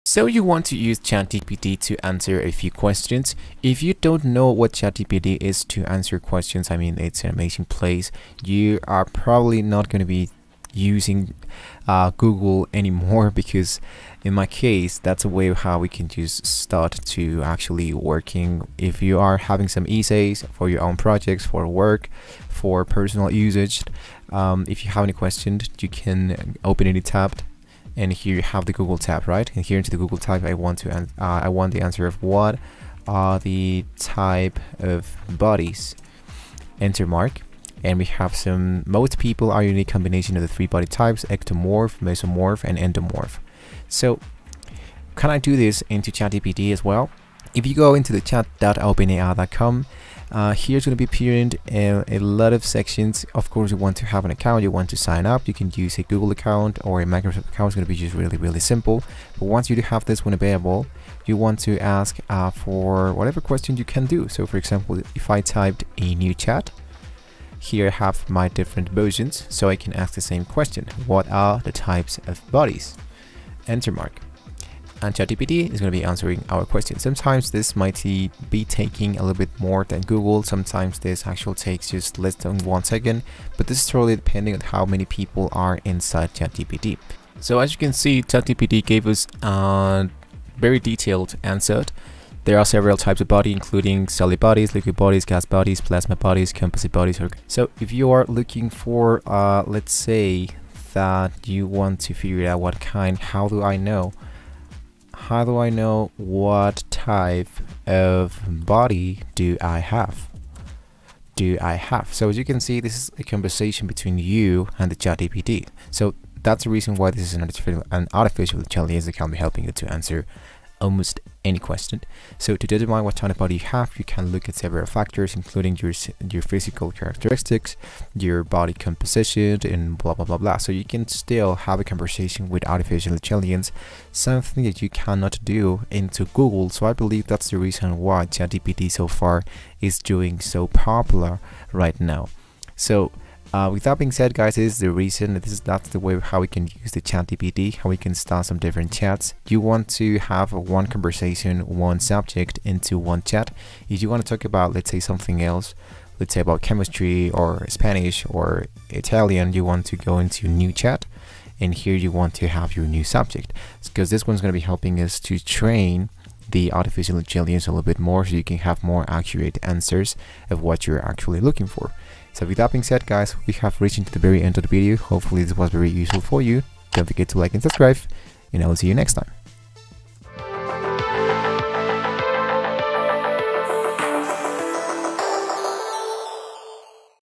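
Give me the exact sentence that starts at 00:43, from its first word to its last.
So, can I do this into ChatGPT as well?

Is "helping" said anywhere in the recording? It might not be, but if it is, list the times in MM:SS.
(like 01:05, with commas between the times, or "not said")
01:59, 02:44.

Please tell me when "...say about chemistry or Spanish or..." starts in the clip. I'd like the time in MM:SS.
02:36.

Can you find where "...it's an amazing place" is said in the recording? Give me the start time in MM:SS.
00:06.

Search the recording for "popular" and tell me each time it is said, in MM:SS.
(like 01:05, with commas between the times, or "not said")
02:20.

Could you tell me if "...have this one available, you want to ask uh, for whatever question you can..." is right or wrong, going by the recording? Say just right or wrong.
right.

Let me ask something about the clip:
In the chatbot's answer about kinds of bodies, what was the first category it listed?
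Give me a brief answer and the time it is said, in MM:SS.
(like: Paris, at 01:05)
solid bodies, at 01:34.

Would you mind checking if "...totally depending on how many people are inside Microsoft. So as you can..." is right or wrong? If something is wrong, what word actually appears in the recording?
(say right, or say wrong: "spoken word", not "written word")
wrong: "ChatGPT", not "Microsoft".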